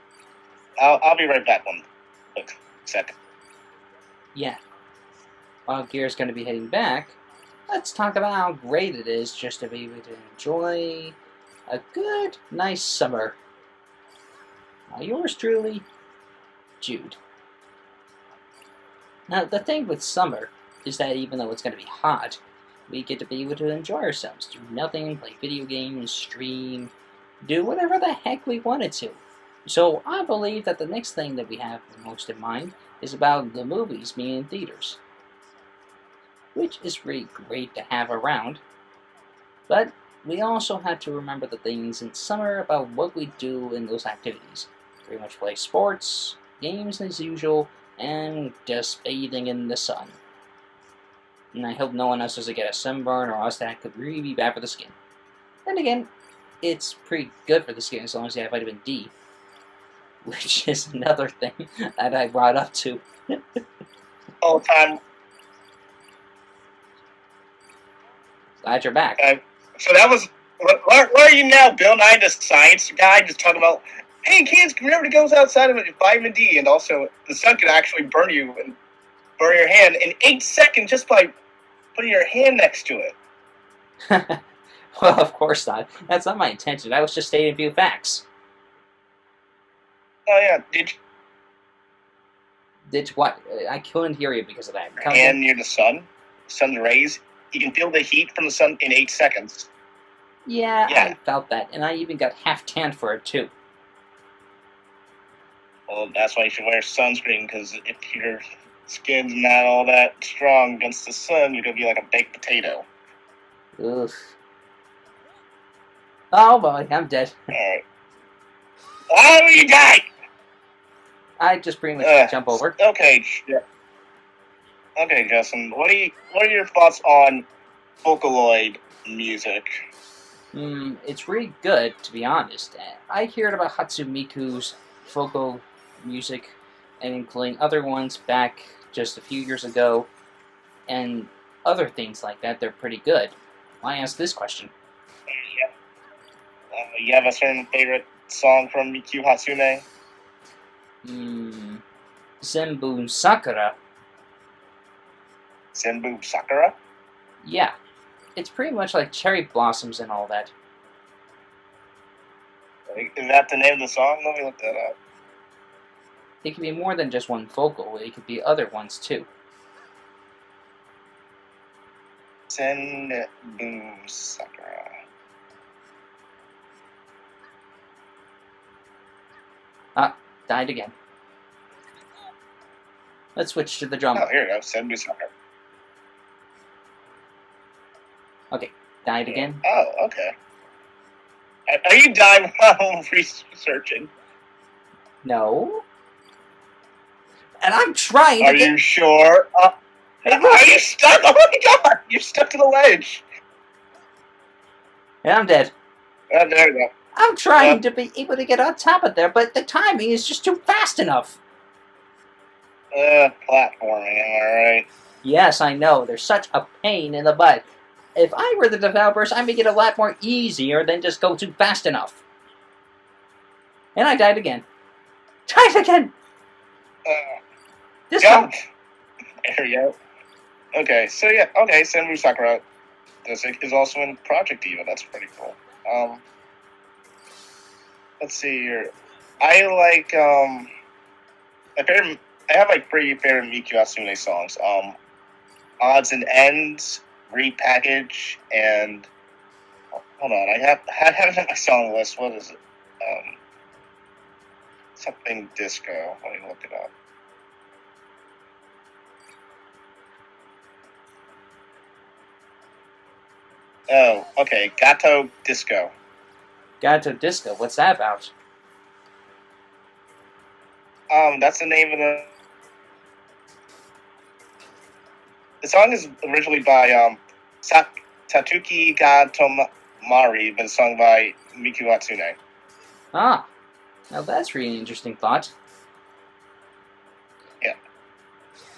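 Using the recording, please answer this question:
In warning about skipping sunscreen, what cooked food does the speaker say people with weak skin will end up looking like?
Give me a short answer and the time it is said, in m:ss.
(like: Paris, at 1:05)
A baked potato, at 1:52.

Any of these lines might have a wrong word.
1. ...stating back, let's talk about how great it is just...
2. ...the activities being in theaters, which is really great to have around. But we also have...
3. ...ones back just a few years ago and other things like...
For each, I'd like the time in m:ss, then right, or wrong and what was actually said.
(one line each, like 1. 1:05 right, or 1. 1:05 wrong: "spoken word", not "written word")
1. 0:06 wrong: "heading", not "stating"
2. 0:33 wrong: "movies", not "activities"
3. 2:17 right.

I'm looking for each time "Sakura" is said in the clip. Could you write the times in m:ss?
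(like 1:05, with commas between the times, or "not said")
2:32.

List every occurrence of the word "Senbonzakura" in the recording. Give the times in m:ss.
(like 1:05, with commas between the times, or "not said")
2:35, 2:52, 3:51.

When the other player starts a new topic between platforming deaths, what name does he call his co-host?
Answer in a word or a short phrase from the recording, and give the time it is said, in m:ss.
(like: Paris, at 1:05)
Justin, at 2:05.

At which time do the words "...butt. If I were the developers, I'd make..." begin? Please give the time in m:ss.
3:37.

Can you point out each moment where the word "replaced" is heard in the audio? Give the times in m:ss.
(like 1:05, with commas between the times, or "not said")
not said.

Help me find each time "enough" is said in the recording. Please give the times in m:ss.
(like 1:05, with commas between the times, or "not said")
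3:30, 3:41.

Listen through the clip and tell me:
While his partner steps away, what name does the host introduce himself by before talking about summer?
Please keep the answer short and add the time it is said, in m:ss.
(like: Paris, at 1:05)
Jude, at 0:16.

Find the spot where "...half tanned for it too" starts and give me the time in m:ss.
1:42.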